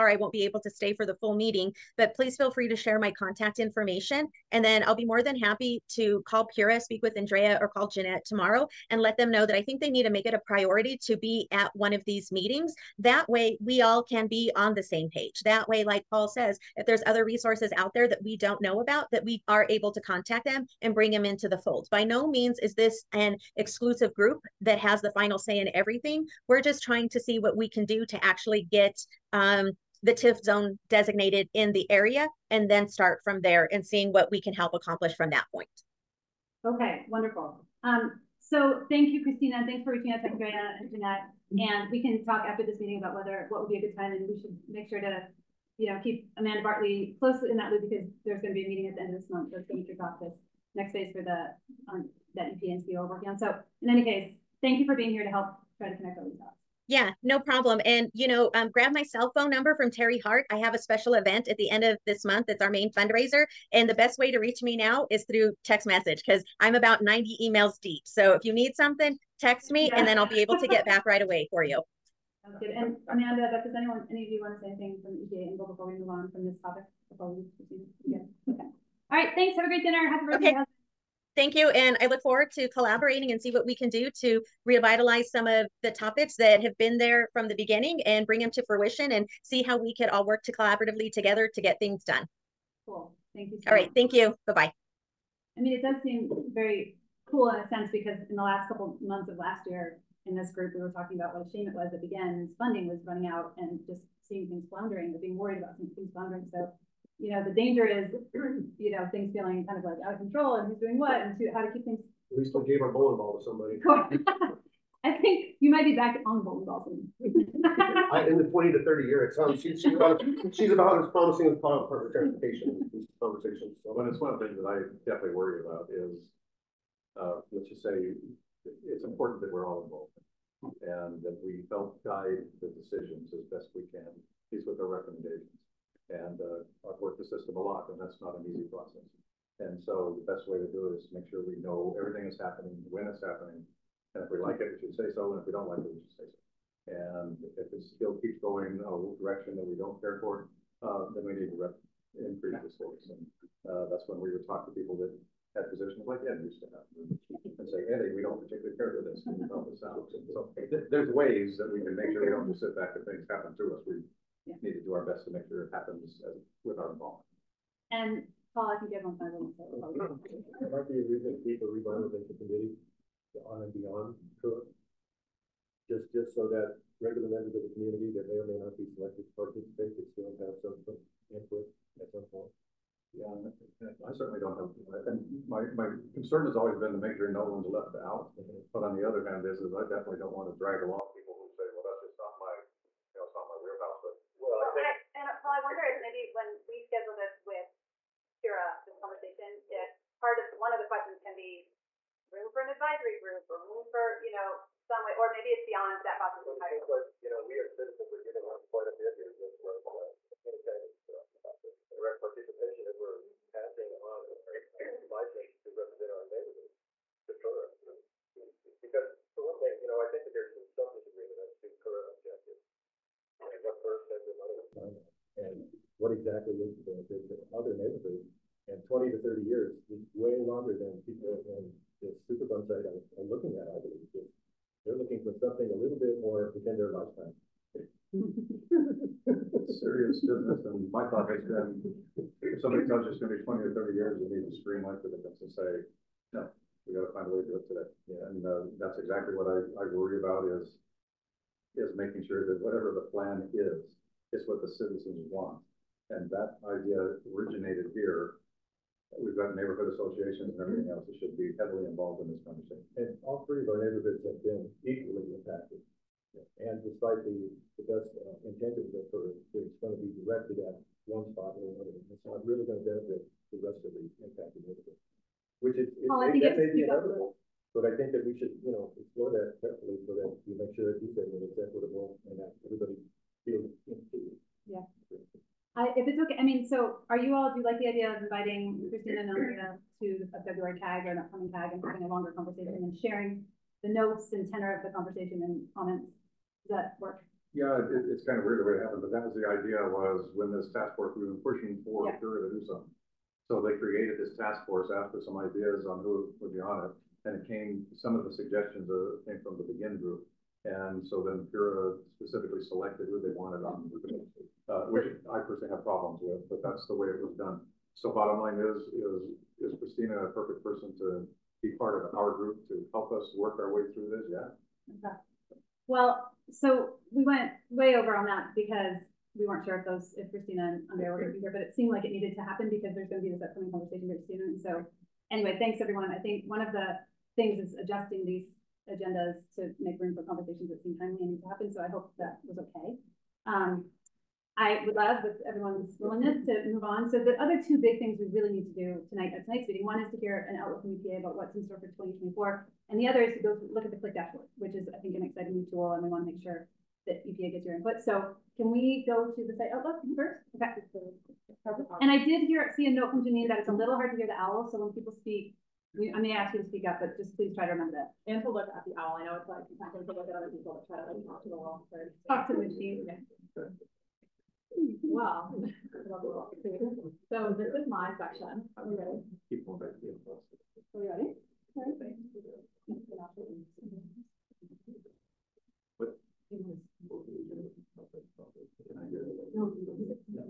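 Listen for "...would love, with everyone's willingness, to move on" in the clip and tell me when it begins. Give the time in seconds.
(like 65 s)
344 s.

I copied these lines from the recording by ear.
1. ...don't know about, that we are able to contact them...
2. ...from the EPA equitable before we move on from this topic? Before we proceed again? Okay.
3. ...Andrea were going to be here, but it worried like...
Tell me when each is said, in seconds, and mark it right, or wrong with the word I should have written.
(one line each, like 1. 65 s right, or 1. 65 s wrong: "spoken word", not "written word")
1. 18 s right
2. 75 s wrong: "angle", not "equitable"
3. 330 s wrong: "seemed", not "worried".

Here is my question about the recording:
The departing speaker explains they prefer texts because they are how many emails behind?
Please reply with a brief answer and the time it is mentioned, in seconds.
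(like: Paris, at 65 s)
90, at 67 s.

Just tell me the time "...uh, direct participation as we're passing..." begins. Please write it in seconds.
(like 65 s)
211 s.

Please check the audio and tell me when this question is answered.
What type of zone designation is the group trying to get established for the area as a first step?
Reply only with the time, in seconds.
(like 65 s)
30 s.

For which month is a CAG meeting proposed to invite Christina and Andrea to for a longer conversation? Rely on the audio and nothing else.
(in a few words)
February.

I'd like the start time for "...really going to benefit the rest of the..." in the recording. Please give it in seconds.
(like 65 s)
272 s.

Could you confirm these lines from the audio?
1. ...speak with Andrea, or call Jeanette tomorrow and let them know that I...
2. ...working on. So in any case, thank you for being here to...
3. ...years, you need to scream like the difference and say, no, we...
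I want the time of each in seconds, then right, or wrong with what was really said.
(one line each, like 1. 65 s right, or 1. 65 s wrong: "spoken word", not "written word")
1. 6 s right
2. 53 s right
3. 243 s right.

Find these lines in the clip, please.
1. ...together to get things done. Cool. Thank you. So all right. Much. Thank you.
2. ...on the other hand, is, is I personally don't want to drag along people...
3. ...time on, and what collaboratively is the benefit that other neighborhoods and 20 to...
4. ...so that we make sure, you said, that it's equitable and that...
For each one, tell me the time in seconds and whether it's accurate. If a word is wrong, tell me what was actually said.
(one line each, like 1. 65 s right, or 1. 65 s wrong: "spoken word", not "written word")
1. 91 s right
2. 188 s wrong: "definitely", not "personally"
3. 224 s wrong: "exactly", not "collaboratively"
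4. 280 s right.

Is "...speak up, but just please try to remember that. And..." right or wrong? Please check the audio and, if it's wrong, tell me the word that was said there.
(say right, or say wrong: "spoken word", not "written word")
right.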